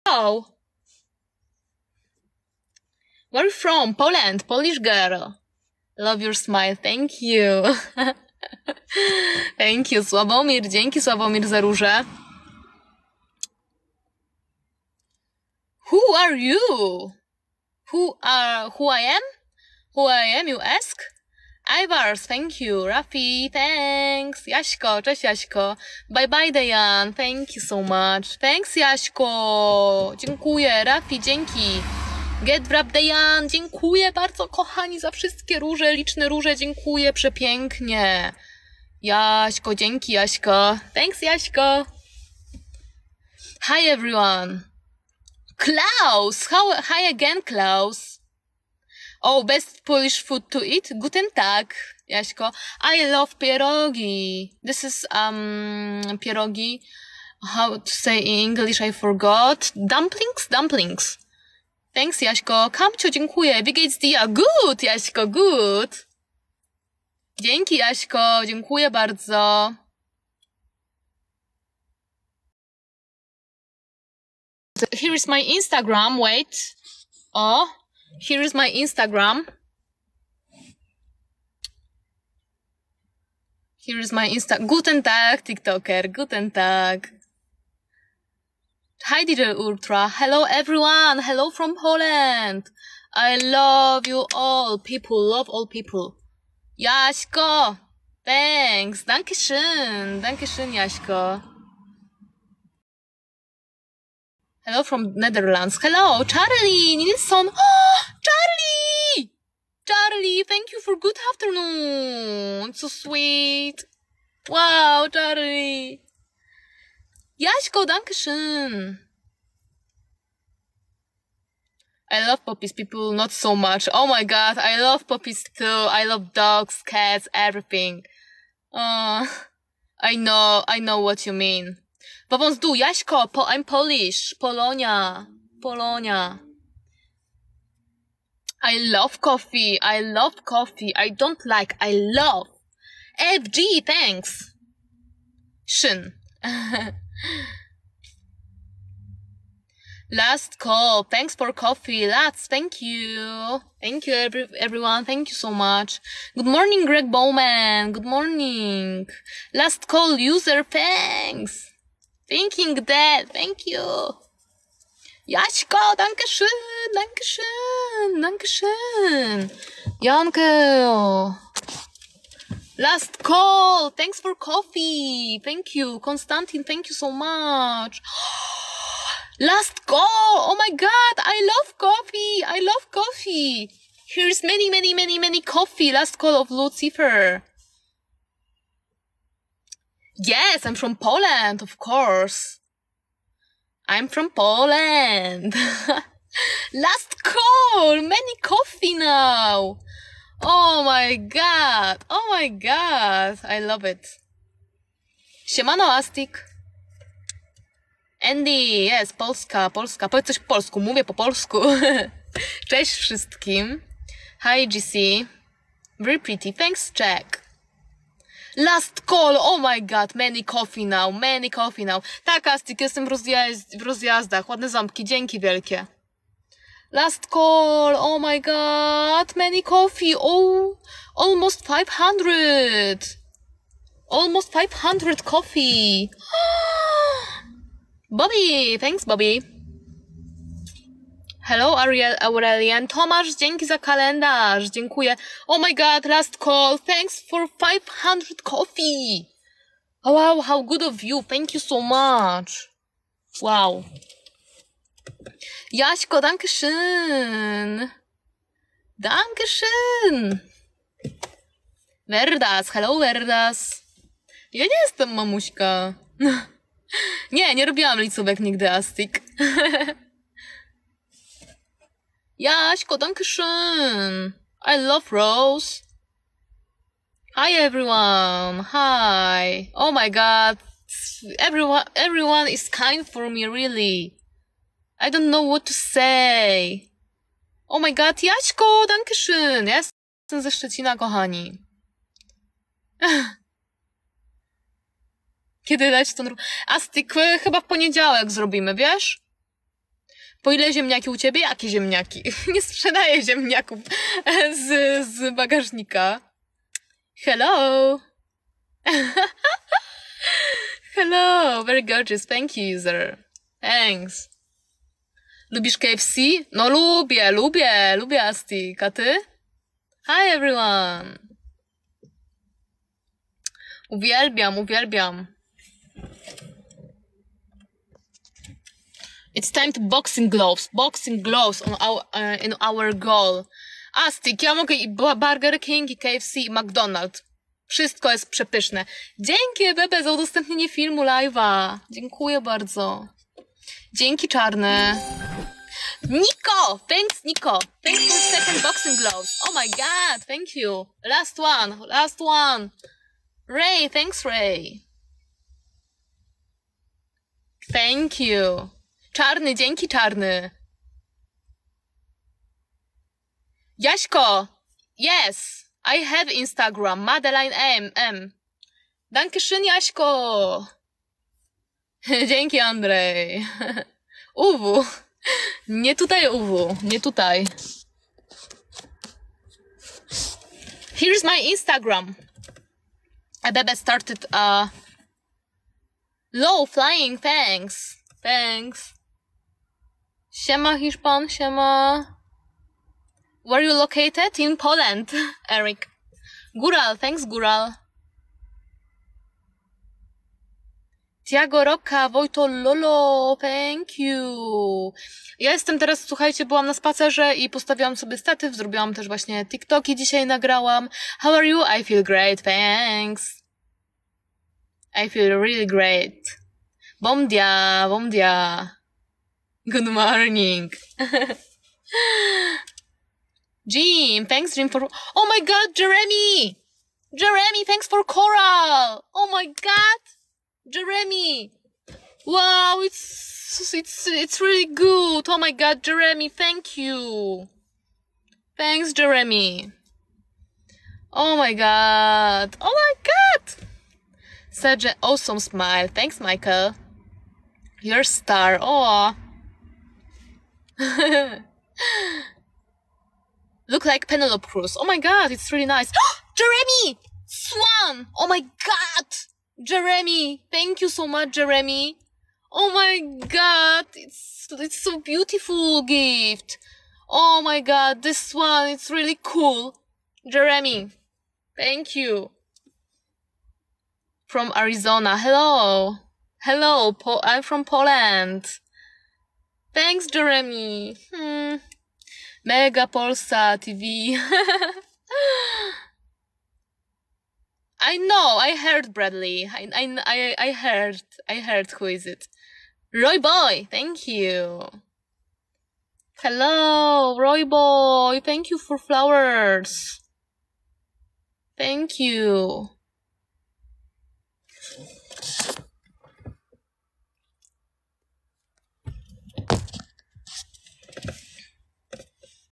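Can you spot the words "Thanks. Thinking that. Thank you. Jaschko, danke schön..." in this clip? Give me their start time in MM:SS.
02:40.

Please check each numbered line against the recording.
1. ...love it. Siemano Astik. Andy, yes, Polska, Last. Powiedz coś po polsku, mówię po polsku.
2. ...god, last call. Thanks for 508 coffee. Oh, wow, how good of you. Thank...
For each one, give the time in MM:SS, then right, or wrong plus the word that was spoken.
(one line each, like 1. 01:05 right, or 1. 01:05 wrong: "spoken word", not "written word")
1. 03:23 wrong: "Polska", not "Last"
2. 04:05 wrong: "500", not "508".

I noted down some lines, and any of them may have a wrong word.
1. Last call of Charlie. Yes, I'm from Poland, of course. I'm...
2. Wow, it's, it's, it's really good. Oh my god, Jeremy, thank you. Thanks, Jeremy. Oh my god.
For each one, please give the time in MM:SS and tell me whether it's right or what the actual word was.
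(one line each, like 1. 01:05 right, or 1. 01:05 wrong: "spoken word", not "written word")
1. 03:05 wrong: "Lucifer", not "Charlie"
2. 07:12 right.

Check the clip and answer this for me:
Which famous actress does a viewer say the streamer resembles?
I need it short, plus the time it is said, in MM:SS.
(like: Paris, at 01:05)
Penelope Cruz, at 07:34.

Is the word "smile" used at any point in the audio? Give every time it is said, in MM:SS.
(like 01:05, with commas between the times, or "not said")
00:06, 07:25.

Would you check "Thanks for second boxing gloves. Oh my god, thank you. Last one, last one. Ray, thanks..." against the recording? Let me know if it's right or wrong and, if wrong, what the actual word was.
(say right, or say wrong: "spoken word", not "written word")
right.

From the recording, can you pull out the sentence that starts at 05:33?
Astik, ja mogę i Burger King, i KFC, i McDonald's.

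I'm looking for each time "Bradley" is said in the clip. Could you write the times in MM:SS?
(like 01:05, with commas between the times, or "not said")
08:08.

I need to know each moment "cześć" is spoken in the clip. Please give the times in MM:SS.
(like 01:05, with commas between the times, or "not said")
00:25, 03:32.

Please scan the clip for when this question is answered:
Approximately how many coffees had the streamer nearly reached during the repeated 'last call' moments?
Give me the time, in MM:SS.
03:54.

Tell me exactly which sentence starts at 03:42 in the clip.
Tak, Astik, jestem w, rozjazd w rozjazdach, ładne ząbki, dzięki wielkie.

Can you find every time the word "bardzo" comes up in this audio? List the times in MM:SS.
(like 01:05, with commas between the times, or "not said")
00:34, 01:08, 05:42.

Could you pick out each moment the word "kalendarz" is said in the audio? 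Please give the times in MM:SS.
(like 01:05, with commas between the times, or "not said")
04:03.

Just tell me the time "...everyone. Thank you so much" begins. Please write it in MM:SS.
02:34.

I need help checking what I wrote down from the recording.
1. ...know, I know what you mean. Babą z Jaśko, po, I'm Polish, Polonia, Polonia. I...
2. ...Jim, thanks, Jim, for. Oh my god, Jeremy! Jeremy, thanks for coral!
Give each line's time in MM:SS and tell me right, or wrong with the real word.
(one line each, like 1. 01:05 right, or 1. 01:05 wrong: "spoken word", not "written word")
1. 02:10 right
2. 07:03 right.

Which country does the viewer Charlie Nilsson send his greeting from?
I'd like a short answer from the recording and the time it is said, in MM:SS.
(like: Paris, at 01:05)
Netherlands, at 01:44.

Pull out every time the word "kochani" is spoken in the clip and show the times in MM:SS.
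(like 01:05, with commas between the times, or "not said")
00:34, 04:50.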